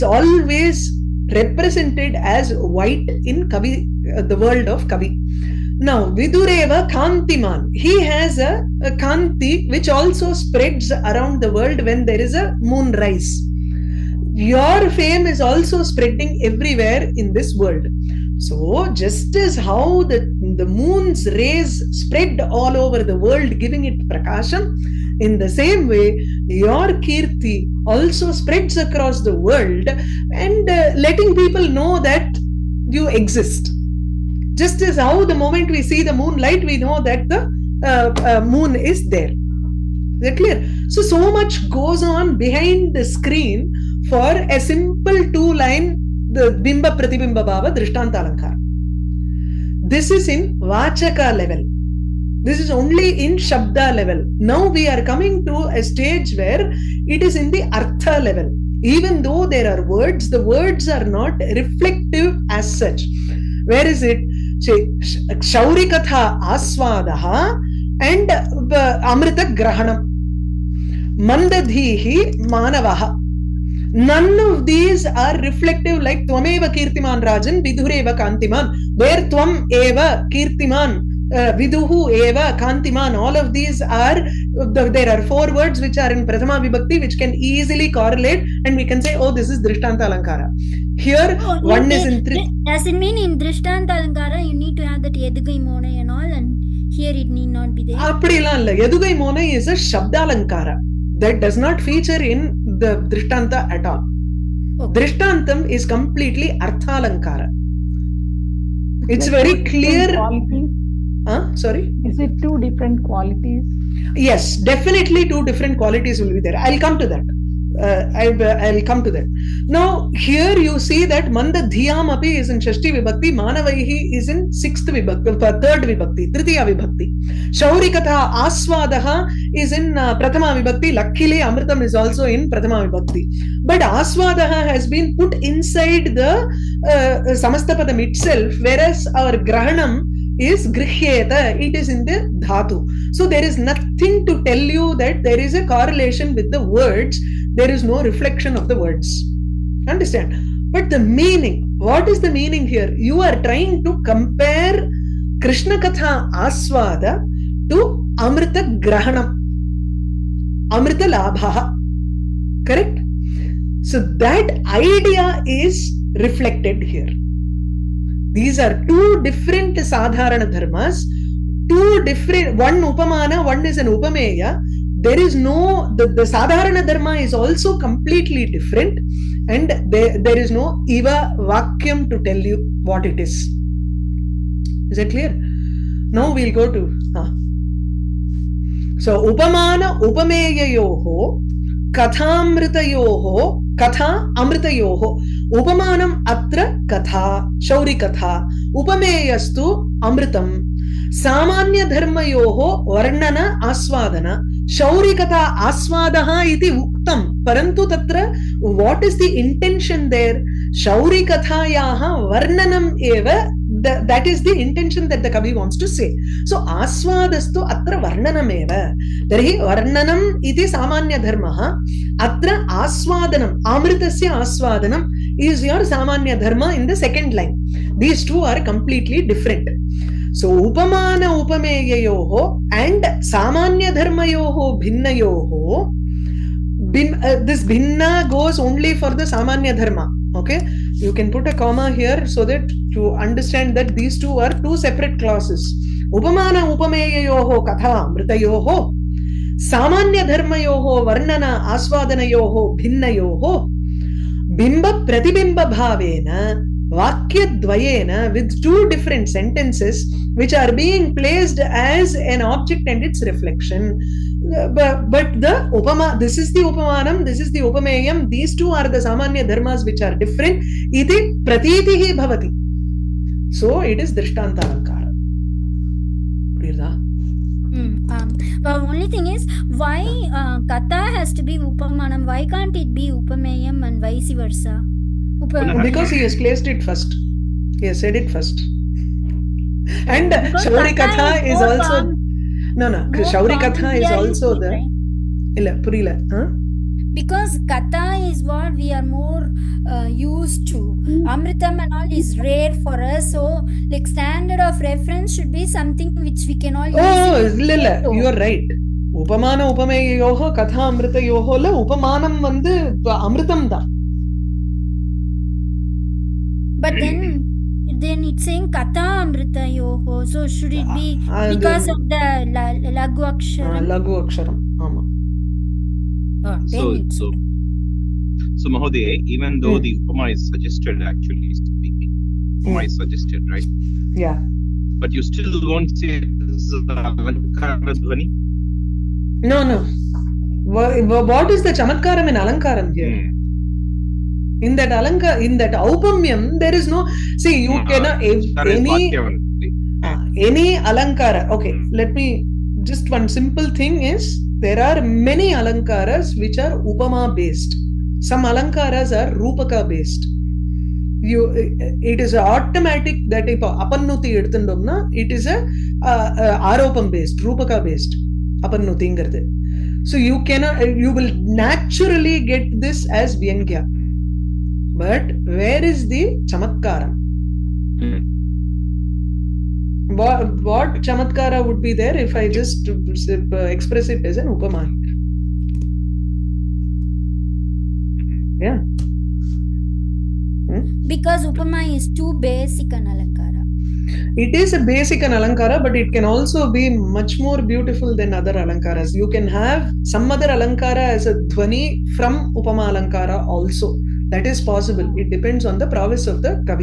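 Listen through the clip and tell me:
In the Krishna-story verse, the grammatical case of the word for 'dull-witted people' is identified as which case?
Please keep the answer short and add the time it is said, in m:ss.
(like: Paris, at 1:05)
Tritiya Vibhakti, at 2:06.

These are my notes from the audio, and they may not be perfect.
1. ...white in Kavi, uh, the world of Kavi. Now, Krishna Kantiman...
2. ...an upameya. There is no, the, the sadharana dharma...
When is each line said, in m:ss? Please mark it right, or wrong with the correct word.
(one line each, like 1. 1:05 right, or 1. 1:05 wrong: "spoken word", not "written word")
1. 0:02 wrong: "Vidureva", not "Krishna"
2. 2:53 right.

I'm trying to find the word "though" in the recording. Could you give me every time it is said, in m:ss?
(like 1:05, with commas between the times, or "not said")
0:59, 5:29.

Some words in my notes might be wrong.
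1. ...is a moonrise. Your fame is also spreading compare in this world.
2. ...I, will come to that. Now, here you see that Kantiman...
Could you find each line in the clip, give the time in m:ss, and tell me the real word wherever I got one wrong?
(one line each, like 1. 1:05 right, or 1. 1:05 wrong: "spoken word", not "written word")
1. 0:12 wrong: "everywhere", not "compare"
2. 1:58 wrong: "Manda", not "Kantiman".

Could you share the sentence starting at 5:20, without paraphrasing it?
So should it be ah, ah, because of the lagu aksharam?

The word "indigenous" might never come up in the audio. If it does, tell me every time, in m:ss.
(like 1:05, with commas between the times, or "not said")
not said.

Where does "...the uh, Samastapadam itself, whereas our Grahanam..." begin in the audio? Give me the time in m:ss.
2:16.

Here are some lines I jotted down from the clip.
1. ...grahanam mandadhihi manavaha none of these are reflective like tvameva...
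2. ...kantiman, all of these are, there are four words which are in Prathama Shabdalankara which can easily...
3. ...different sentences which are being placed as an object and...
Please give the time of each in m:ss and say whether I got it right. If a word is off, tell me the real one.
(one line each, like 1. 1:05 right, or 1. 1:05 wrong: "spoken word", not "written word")
1. 1:09 right
2. 1:22 wrong: "Vibhakti", not "Shabdalankara"
3. 4:18 right.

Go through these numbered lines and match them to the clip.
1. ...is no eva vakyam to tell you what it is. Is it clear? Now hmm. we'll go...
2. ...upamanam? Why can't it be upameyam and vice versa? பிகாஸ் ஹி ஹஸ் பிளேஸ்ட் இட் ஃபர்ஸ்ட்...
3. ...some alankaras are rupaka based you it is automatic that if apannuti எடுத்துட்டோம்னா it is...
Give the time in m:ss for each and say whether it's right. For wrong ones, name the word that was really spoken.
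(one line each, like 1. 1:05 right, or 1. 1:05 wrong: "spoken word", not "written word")
1. 3:00 right
2. 4:41 right
3. 5:58 right.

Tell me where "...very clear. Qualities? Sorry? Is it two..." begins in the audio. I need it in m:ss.
1:49.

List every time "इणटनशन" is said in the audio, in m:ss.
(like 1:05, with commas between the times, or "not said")
3:29, 3:34.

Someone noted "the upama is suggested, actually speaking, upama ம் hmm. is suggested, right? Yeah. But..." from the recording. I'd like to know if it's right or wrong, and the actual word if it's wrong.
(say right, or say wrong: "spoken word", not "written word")
right.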